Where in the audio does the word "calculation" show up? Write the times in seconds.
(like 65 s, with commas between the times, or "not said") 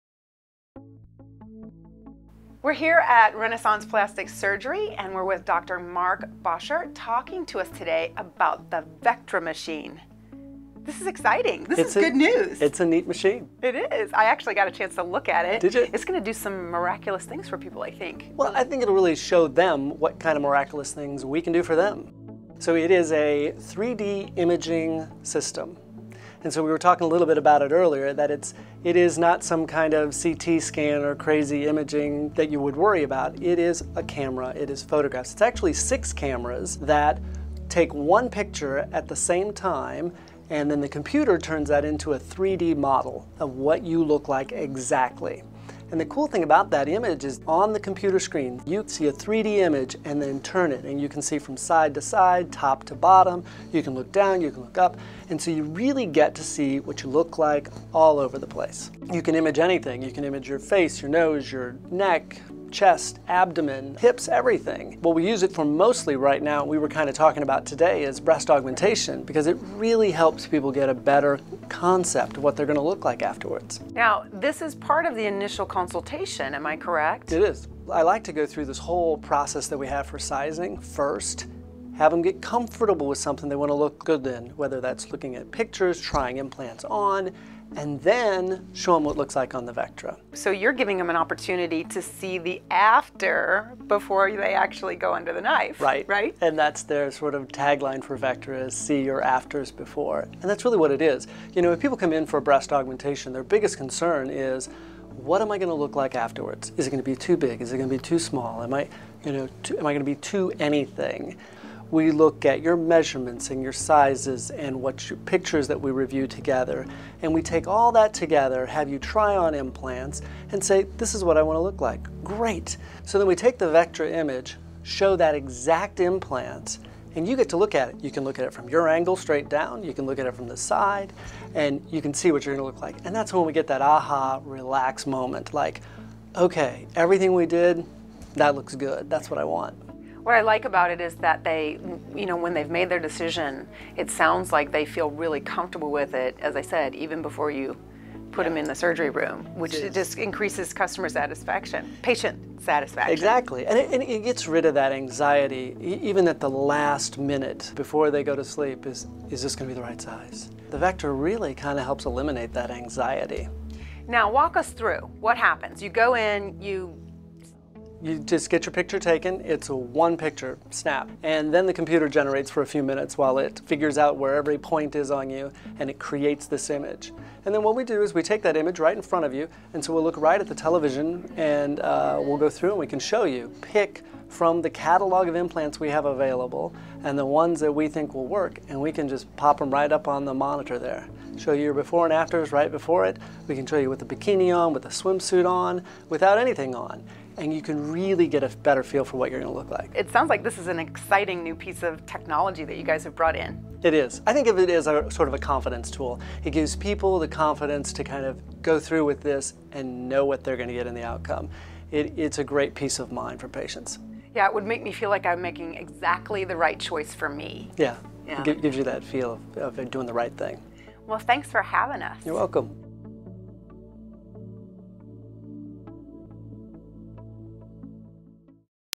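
not said.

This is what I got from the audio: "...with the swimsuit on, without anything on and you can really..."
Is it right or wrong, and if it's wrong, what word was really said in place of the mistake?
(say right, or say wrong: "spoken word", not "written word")
right.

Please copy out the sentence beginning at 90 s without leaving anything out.
So you're giving them an opportunity to see the after before they actually go under the knife.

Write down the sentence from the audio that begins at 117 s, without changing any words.
And we take all that together, have you try on implants and say, this is what I want to look like.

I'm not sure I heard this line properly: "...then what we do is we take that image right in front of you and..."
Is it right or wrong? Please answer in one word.
right.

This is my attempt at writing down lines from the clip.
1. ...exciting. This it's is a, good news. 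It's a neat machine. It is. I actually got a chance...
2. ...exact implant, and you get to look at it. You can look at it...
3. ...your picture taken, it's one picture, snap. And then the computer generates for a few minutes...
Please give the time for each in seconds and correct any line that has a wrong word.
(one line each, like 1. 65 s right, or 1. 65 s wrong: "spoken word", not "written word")
1. 11 s right
2. 125 s right
3. 168 s right.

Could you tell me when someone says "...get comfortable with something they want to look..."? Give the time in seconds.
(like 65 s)
82 s.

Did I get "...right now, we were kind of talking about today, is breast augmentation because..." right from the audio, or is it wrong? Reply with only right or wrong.
right.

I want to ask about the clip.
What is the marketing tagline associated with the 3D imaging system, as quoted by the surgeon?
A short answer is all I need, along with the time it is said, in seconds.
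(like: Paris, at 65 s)
See your afters before, at 98 s.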